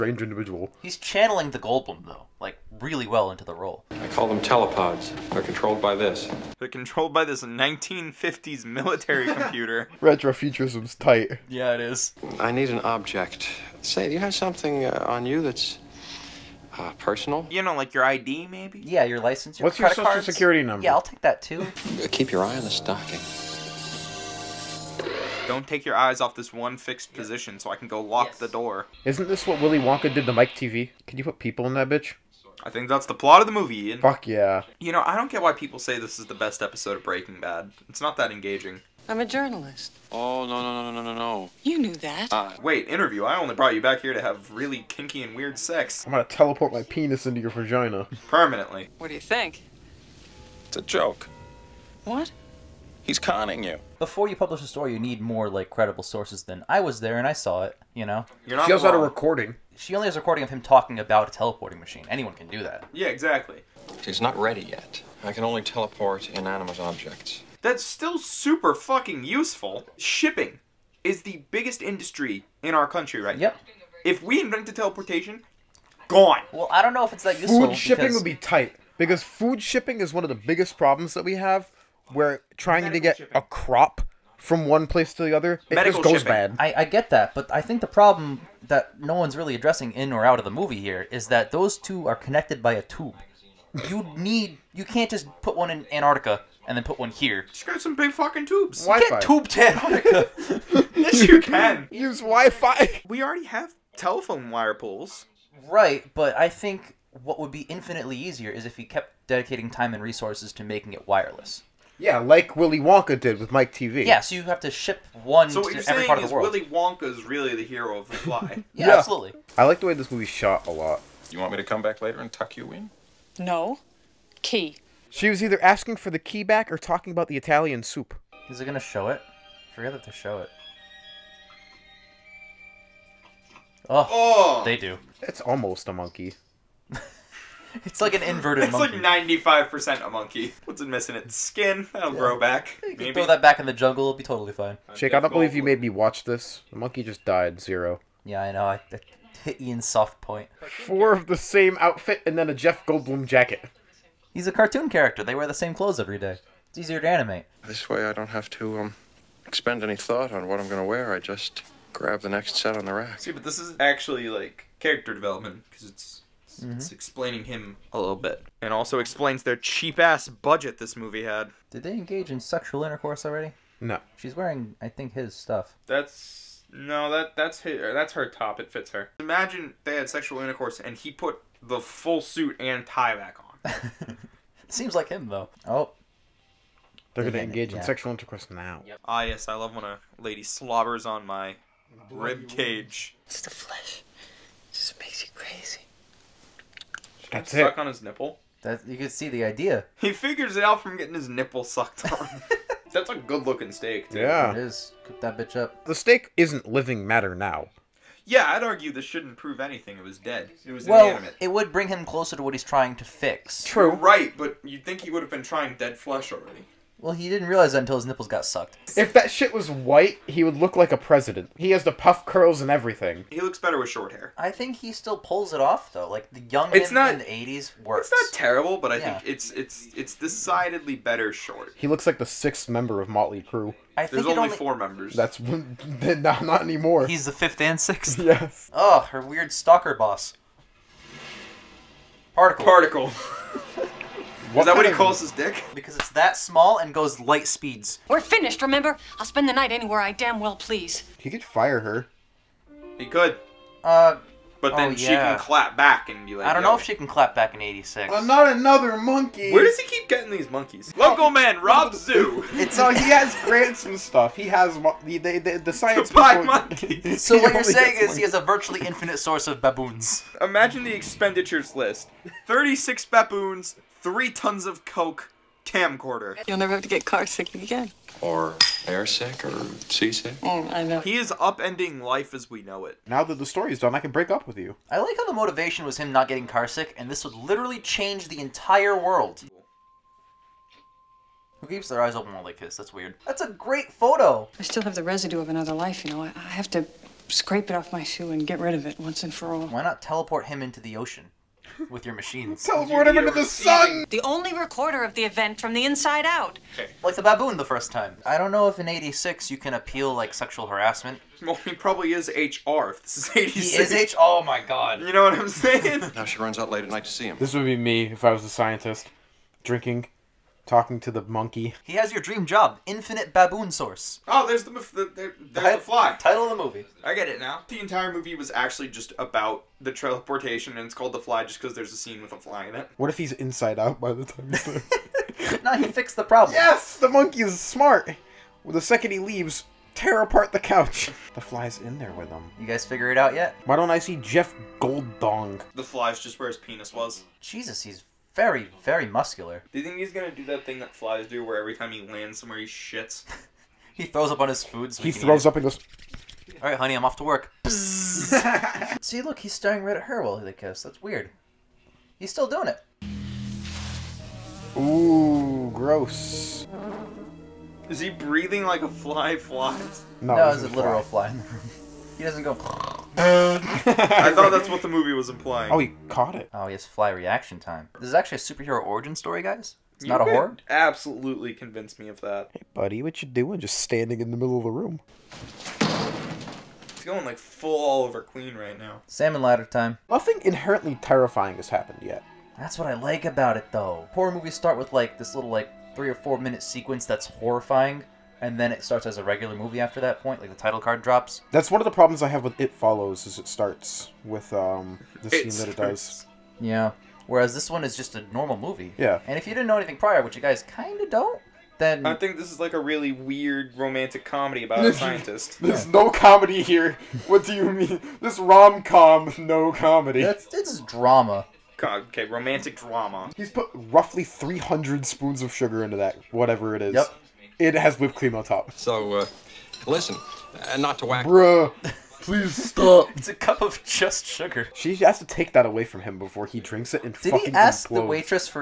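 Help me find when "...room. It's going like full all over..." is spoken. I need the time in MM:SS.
06:24.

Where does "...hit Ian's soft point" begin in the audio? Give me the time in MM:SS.
02:29.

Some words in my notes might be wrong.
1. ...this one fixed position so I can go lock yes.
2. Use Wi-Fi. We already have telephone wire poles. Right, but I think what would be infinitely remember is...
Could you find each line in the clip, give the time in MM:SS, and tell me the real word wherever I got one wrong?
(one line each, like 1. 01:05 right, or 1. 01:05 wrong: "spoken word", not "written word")
1. 00:26 right
2. 01:41 wrong: "easier", not "remember".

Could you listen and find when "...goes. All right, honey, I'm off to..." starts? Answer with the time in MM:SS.
05:55.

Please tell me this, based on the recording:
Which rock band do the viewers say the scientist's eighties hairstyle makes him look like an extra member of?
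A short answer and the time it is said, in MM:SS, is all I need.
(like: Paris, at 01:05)
Motley Crue, at 03:53.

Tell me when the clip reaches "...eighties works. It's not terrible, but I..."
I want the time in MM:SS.
03:47.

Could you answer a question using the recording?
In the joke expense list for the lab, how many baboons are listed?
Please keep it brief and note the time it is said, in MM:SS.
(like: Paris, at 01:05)
36, at 04:32.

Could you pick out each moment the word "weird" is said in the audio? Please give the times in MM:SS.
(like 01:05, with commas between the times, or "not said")
00:45, 03:59, 04:52, 06:01, 06:53.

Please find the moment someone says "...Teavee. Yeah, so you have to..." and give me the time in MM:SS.
01:53.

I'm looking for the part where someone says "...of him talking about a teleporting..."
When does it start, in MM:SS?
01:00.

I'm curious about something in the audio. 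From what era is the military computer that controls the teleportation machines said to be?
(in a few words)
1950s.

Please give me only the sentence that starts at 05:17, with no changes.
This would be me if I was a scientist.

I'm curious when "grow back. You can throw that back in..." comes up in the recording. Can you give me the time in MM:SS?
02:22.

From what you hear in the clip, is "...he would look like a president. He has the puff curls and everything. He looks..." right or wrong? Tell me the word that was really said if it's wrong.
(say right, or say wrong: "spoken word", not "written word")
right.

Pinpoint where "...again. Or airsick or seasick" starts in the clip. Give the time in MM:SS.
04:37.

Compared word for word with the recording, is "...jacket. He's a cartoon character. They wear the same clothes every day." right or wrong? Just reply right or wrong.
right.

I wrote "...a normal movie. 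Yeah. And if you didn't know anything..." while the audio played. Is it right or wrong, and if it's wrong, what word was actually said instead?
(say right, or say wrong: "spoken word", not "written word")
right.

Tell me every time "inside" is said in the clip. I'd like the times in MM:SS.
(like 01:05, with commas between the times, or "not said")
05:05, 05:33.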